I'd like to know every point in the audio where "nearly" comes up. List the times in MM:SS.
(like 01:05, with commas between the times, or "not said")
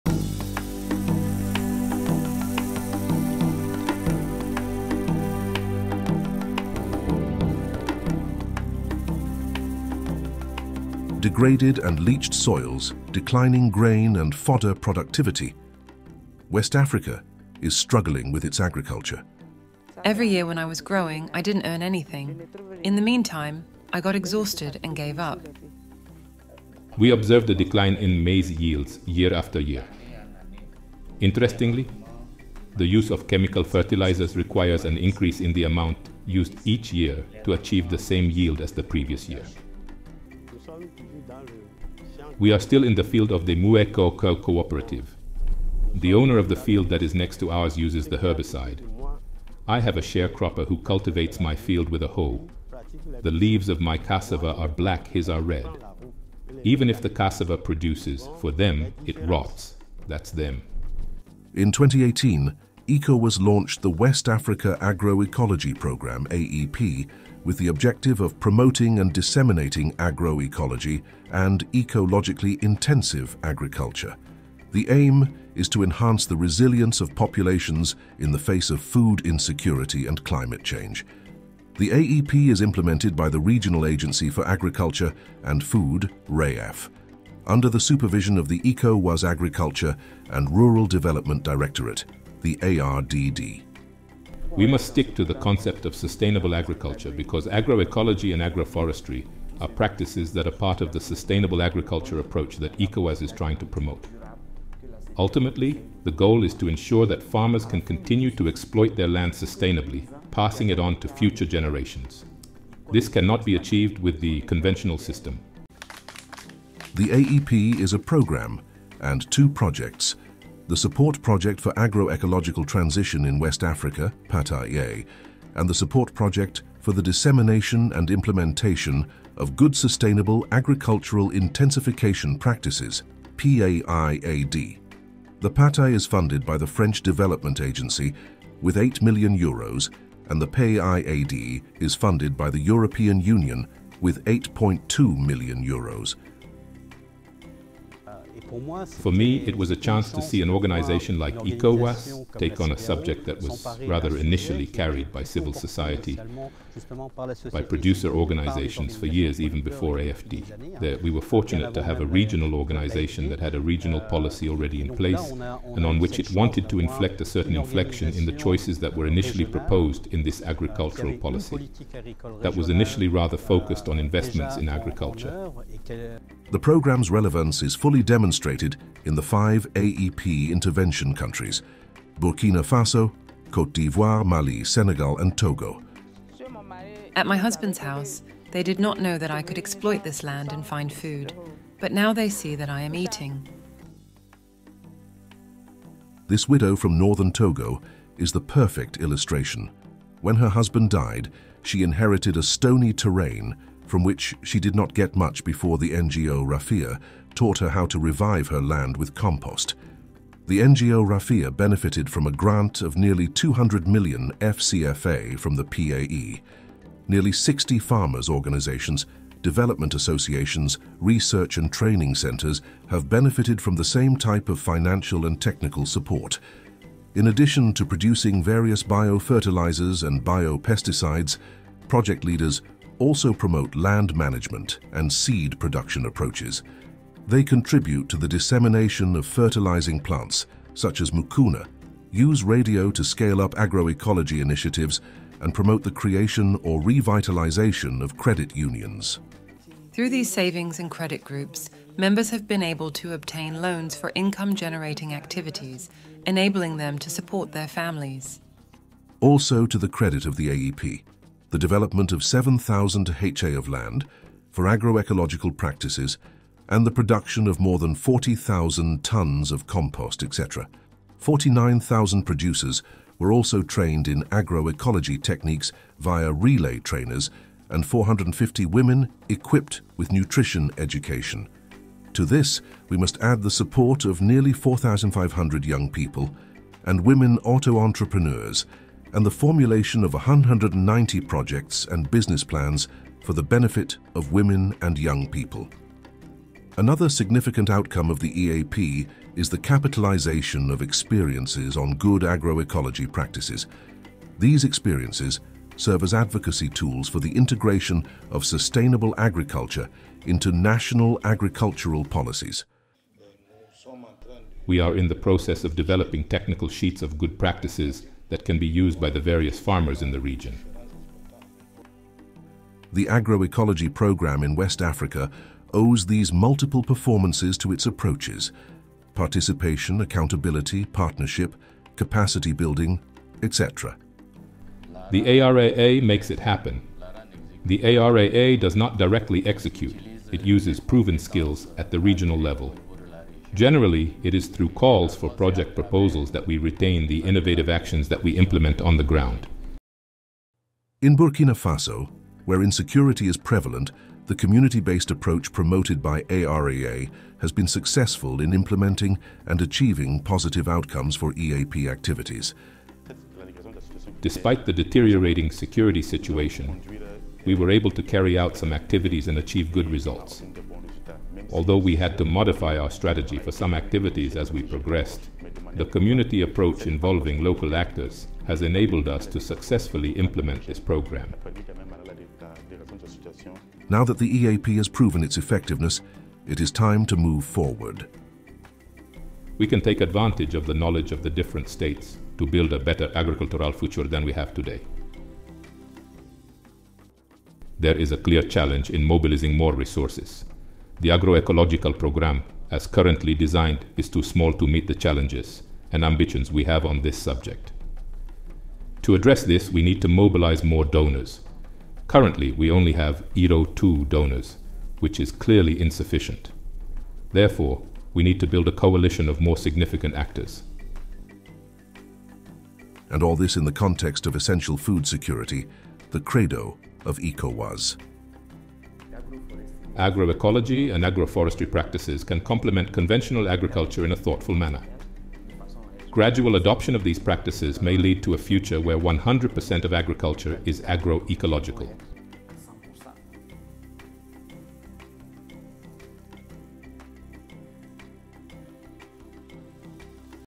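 03:32, 03:37, 04:44.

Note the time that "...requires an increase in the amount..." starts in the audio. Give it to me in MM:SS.
00:34.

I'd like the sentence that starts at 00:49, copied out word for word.
I have a sharecropper who cultivates my field with a hoe.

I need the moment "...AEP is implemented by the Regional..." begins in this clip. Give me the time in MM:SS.
01:21.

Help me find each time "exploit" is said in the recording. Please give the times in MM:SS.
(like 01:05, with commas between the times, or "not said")
01:48, 03:09.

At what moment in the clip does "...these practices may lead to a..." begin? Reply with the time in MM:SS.
07:17.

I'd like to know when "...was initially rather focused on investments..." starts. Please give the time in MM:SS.
02:52.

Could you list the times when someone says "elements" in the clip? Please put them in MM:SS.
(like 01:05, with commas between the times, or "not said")
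not said.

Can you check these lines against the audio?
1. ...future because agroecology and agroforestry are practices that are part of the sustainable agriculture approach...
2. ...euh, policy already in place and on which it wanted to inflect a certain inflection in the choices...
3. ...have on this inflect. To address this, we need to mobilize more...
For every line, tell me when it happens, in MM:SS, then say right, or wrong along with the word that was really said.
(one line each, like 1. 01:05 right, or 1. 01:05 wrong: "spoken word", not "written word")
1. 01:36 wrong: "agriculture", not "future"
2. 02:44 right
3. 06:46 wrong: "subject", not "inflect".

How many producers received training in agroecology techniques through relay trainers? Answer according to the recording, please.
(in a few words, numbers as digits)
49,000.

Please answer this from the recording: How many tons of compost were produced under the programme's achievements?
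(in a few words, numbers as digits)
40,000 tons.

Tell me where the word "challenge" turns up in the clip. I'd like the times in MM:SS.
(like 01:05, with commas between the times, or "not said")
06:38, 06:44.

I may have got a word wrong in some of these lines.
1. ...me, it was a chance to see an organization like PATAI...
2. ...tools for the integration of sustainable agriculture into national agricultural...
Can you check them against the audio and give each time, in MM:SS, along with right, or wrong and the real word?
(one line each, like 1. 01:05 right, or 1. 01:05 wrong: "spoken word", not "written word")
1. 02:29 wrong: "ECOWAS", not "PATAI"
2. 05:06 right.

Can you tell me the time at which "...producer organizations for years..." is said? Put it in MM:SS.
02:37.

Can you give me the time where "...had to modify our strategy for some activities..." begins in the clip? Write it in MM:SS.
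06:11.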